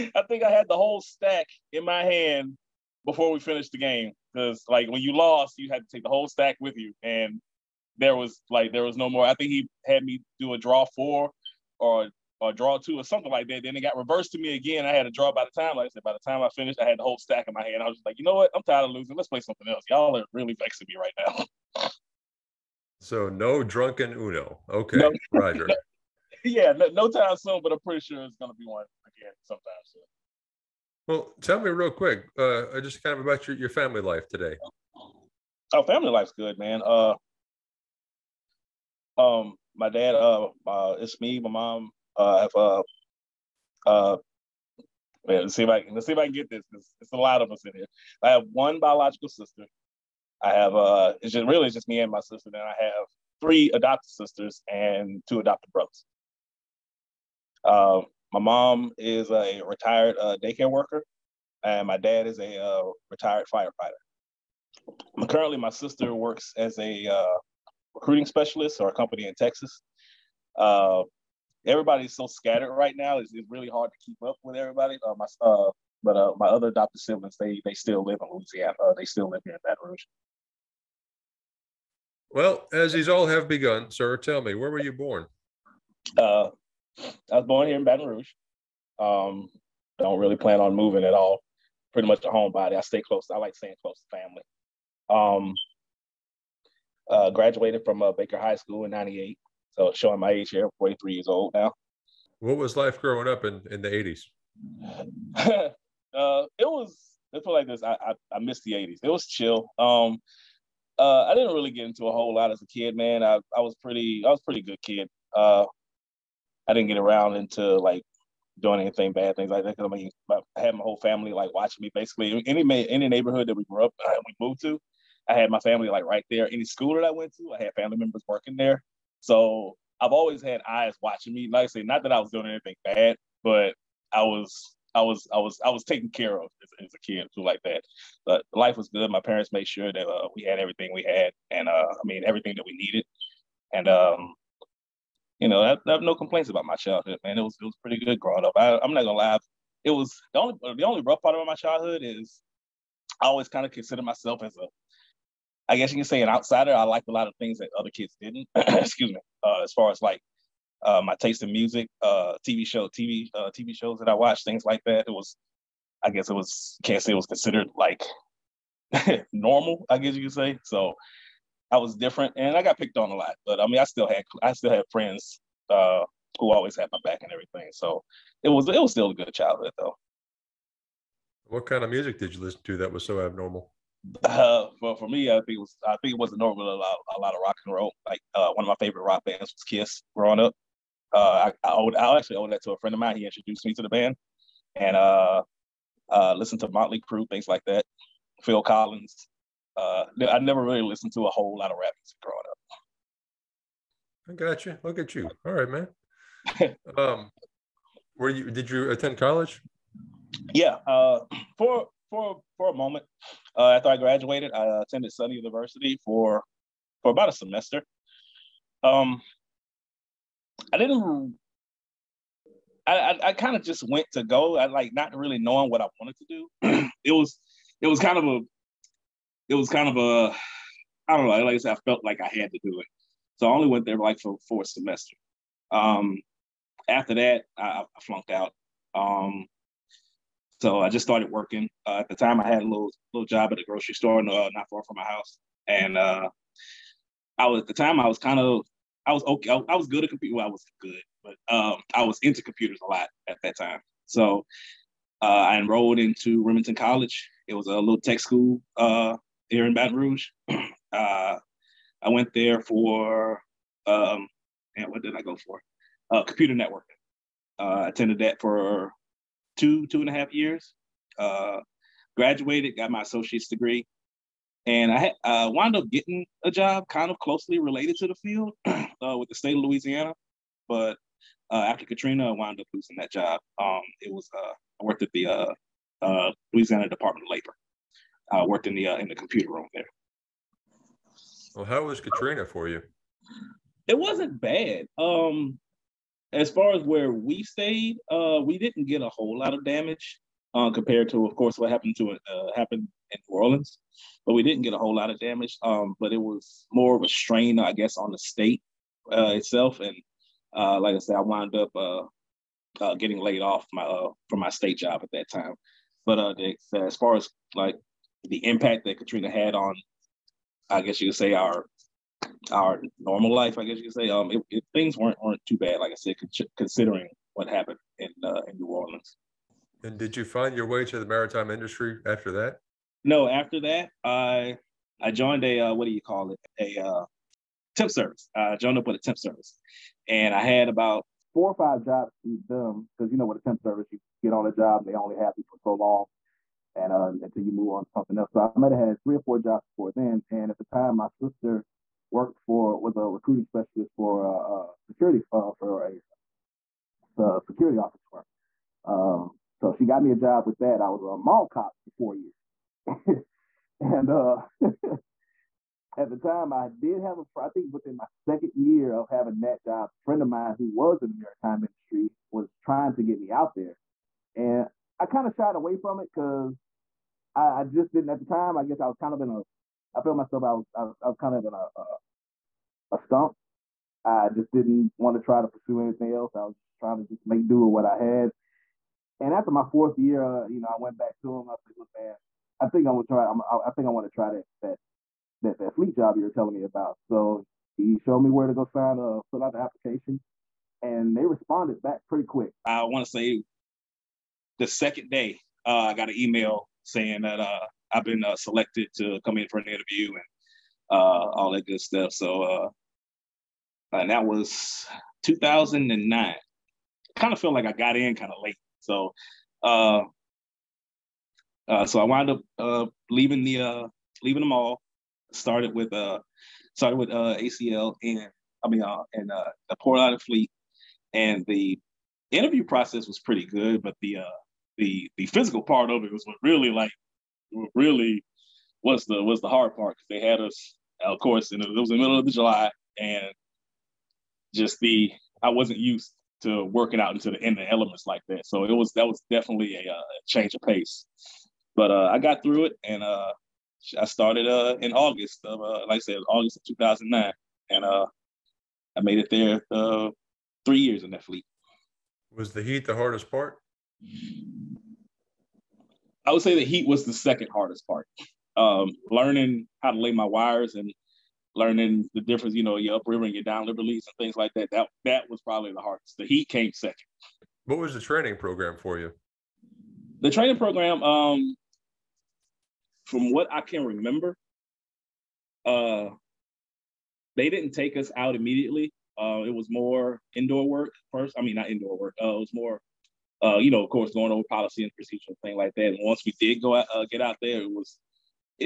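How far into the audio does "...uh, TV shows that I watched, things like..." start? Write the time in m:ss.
2:43.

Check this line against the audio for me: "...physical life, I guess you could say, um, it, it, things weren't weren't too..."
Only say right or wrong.
wrong.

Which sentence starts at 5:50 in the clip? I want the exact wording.
And at the time, my sister worked for was a recruiting specialist for a security uh, for a, a security office firm.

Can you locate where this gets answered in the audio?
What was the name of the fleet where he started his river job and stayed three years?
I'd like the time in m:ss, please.
7:09.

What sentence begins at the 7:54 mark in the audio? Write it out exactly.
That that was probably the hardest.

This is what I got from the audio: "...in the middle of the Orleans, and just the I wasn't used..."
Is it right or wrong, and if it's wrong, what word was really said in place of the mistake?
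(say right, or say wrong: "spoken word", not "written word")
wrong: "July", not "Orleans".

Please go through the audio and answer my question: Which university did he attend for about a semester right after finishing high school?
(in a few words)
Southern University.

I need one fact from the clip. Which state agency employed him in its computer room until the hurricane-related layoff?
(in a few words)
Louisiana Department of Labor.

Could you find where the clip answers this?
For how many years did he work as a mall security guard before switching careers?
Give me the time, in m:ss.
6:01.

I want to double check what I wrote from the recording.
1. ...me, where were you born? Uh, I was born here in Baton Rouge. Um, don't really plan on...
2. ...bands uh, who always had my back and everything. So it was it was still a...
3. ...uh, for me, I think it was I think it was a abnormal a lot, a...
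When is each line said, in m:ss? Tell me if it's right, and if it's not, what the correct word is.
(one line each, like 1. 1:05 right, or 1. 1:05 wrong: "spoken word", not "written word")
1. 1:24 right
2. 2:54 wrong: "friends", not "bands"
3. 3:04 wrong: "normal", not "abnormal".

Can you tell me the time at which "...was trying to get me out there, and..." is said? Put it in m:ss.
6:12.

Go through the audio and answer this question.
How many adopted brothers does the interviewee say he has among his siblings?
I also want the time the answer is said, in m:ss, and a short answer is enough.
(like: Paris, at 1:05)
2, at 0:55.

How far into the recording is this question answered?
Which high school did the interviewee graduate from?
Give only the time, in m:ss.
1:38.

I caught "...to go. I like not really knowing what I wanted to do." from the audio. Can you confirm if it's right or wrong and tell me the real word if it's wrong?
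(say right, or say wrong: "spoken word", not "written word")
right.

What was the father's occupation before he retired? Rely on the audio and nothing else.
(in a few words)
Firefighter.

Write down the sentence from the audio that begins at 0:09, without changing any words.
I think he had me do a draw four or or draw two or something like that.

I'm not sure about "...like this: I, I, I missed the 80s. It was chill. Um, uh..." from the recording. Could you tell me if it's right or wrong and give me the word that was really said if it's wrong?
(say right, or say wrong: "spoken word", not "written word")
right.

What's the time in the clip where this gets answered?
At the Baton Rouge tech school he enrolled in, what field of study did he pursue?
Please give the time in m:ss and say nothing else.
4:26.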